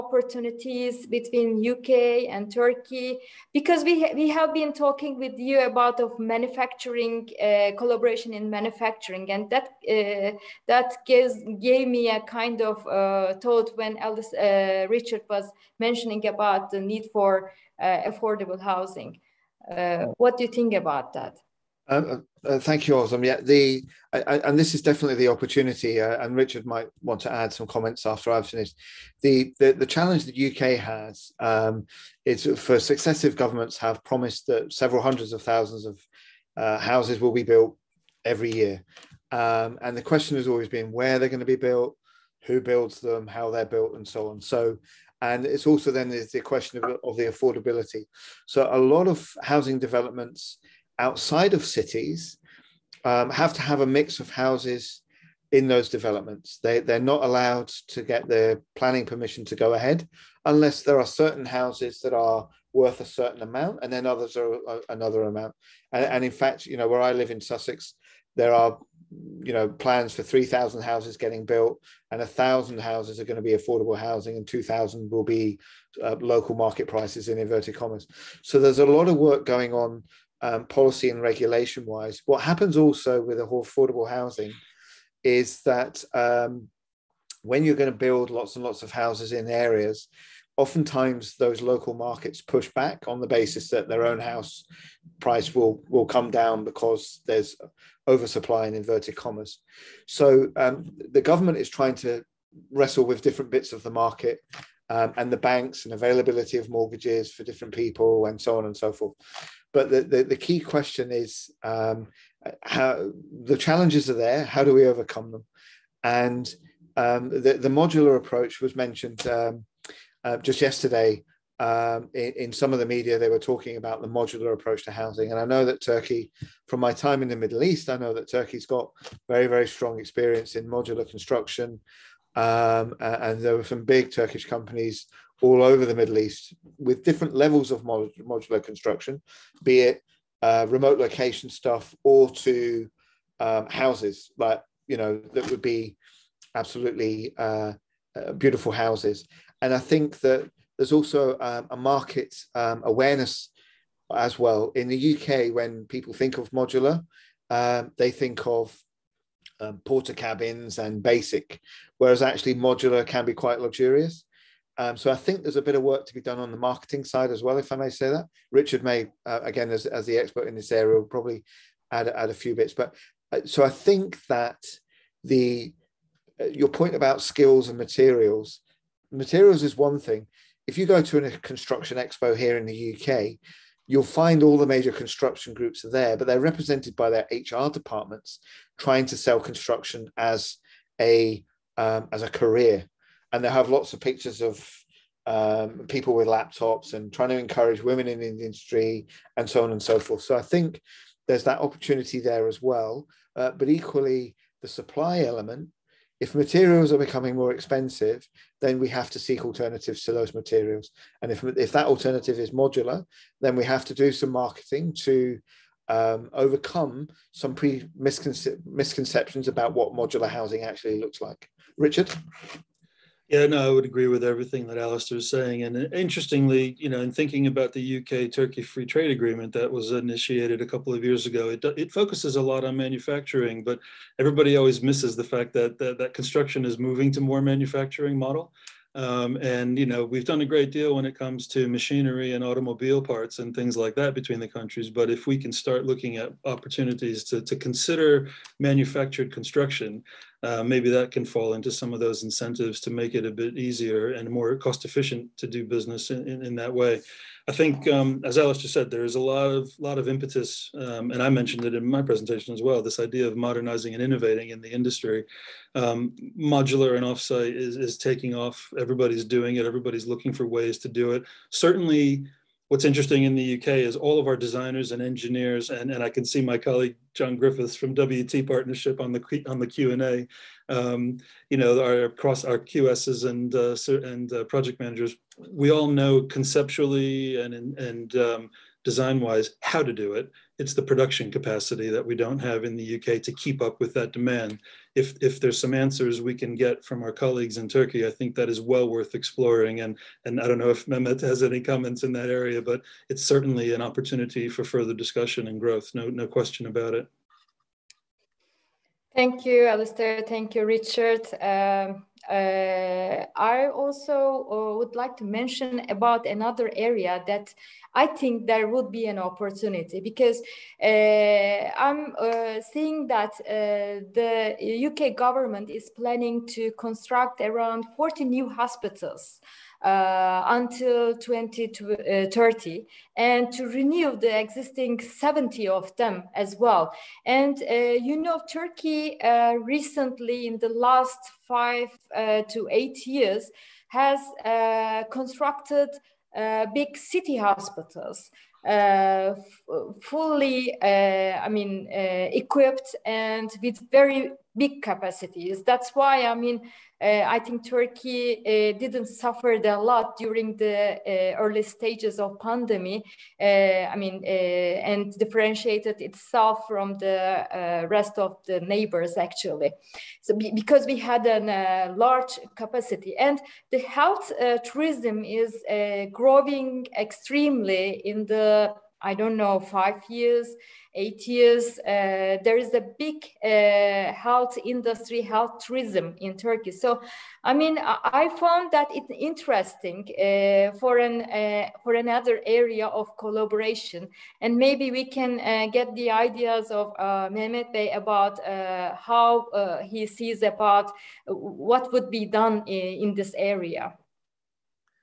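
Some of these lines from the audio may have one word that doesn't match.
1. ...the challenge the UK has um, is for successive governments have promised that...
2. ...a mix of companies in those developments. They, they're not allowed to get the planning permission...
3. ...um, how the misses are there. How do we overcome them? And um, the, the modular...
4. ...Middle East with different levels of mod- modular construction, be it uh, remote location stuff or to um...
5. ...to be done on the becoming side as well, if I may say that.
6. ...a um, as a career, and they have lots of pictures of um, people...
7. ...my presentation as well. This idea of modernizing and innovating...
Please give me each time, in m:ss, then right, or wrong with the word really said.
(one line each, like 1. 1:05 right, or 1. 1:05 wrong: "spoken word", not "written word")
1. 0:29 right
2. 0:53 wrong: "houses", not "companies"
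3. 1:51 wrong: "challenges", not "misses"
4. 2:15 right
5. 2:46 wrong: "marketing", not "becoming"
6. 3:11 right
7. 4:21 right.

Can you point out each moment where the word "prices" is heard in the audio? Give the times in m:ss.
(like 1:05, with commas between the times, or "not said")
1:16, 1:35.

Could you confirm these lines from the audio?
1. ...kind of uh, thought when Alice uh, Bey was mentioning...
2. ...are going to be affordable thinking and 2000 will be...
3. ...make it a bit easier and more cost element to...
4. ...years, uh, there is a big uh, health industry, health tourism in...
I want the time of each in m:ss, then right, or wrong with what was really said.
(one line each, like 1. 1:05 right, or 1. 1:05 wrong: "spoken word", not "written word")
1. 0:12 wrong: "Richard", not "Bey"
2. 1:13 wrong: "housing", not "thinking"
3. 4:12 wrong: "efficient", not "element"
4. 6:21 right.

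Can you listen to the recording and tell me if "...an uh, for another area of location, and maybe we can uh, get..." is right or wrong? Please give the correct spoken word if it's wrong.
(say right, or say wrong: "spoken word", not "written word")
wrong: "collaboration", not "location".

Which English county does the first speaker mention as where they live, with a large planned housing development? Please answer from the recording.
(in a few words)
Sussex.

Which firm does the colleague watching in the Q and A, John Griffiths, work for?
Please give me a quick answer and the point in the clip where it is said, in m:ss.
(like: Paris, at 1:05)
WT Partnership, at 4:37.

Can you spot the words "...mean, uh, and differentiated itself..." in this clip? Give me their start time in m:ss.
6:03.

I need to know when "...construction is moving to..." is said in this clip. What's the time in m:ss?
3:56.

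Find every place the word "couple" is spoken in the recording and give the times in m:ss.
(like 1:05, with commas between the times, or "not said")
3:50.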